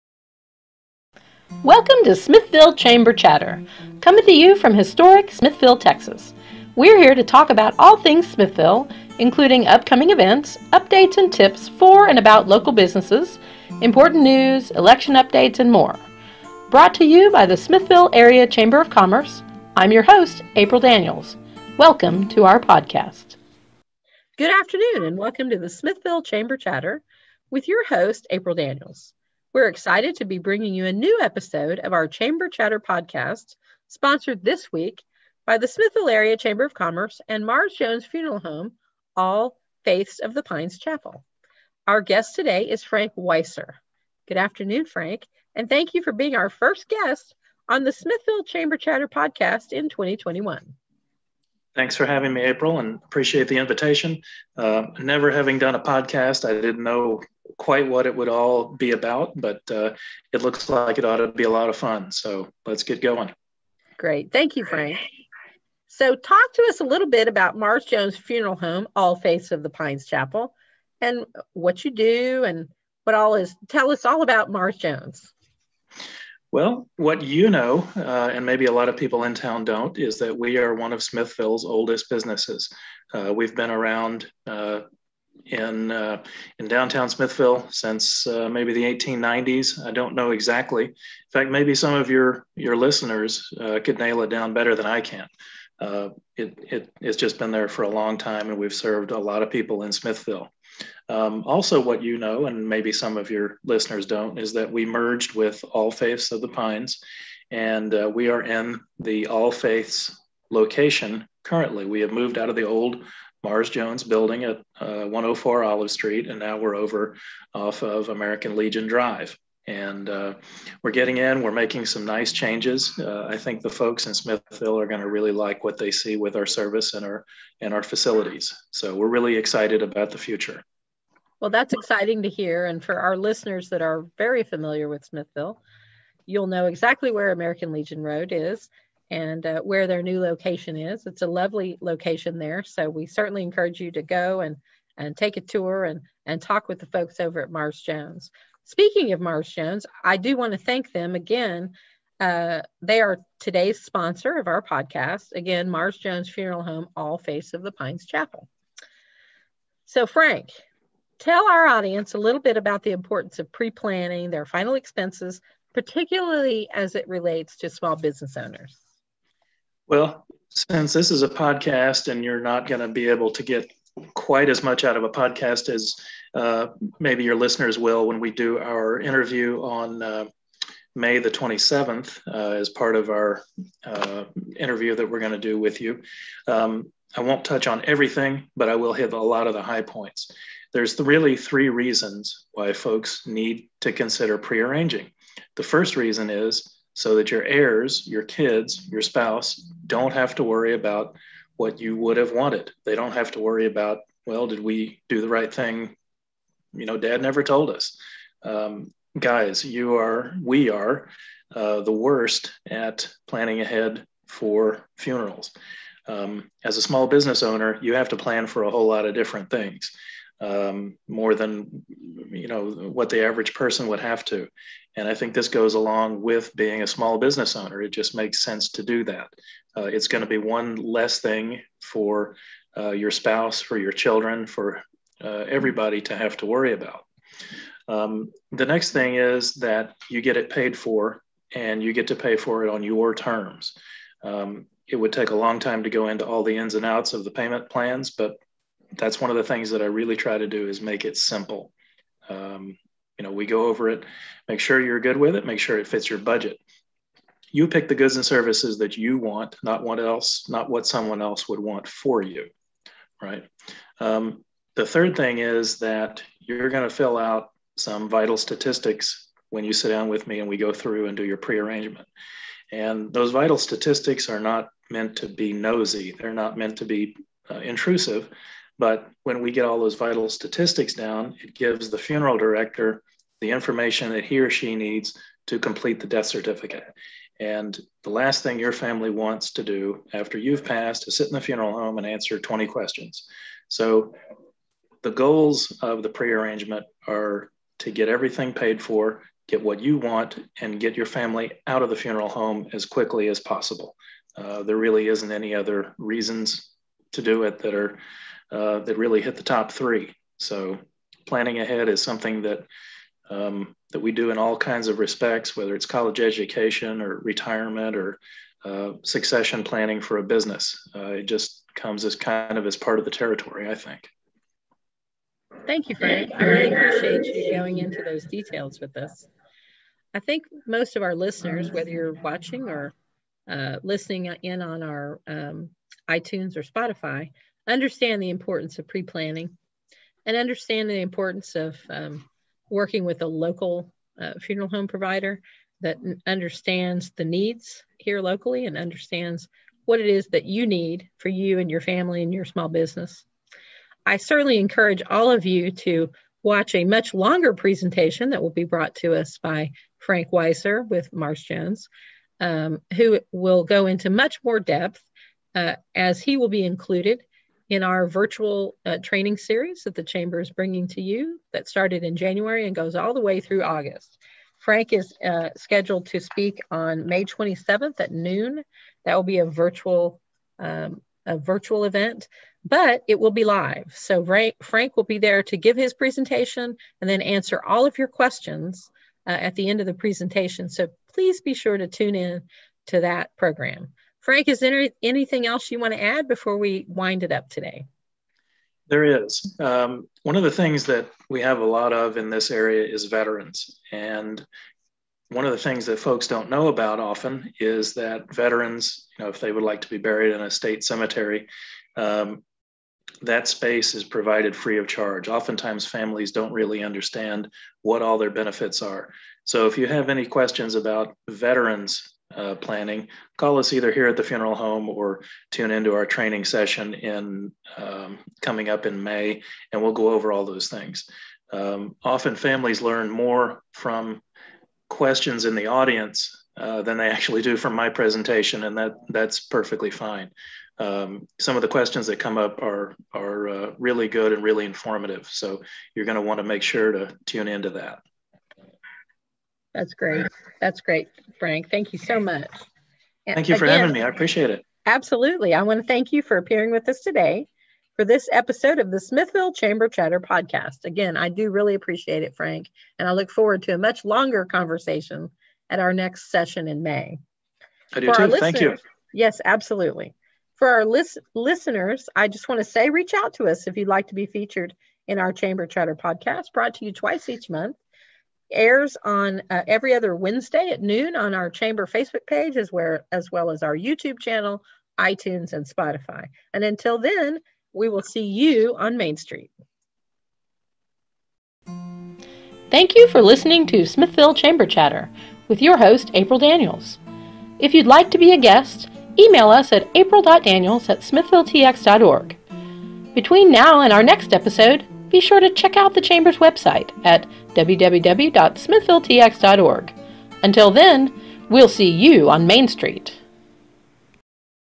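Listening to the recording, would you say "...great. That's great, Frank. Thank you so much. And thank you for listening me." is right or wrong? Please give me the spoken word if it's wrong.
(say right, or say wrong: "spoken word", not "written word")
wrong: "having", not "listening".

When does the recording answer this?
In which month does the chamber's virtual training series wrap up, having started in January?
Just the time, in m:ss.
6:13.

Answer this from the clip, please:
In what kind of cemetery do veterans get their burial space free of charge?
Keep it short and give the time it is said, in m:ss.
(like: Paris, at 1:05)
State cemetery, at 6:50.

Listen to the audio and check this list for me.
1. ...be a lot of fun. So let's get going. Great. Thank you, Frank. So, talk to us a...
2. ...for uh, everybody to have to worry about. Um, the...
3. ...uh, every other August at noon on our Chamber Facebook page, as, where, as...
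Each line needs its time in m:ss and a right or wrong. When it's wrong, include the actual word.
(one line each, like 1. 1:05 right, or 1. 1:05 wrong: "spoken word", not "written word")
1. 1:01 right
2. 3:54 right
3. 7:59 wrong: "Wednesday", not "August".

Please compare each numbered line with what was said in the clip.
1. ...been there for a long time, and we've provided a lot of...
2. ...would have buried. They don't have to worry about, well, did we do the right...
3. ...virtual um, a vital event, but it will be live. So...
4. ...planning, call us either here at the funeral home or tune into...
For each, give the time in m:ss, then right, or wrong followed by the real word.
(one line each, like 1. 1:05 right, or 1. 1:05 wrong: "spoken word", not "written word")
1. 1:37 wrong: "served", not "provided"
2. 3:21 wrong: "wanted", not "buried"
3. 6:19 wrong: "virtual", not "vital"
4. 7:02 right.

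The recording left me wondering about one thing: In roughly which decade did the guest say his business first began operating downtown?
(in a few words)
1890s.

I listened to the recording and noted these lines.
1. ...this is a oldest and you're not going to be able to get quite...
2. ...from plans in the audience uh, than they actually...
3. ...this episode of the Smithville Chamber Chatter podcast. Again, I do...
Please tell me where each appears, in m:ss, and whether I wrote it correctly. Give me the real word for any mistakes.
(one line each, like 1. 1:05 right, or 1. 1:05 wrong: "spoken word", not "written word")
1. 2:50 wrong: "podcast", not "oldest"
2. 7:13 wrong: "questions", not "plans"
3. 7:38 right.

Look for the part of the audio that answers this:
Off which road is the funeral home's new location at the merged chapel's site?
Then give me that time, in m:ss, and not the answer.
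1:58.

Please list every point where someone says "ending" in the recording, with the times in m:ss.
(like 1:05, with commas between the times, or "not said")
not said.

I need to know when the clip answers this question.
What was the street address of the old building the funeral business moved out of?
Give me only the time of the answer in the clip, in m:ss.
1:55.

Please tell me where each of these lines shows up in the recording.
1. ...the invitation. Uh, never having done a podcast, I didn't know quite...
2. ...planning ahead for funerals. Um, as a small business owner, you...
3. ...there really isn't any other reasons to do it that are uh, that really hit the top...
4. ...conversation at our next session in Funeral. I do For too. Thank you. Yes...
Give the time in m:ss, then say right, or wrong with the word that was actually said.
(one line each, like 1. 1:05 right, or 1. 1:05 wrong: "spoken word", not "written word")
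1. 0:53 right
2. 3:33 right
3. 5:04 right
4. 7:44 wrong: "May", not "Funeral".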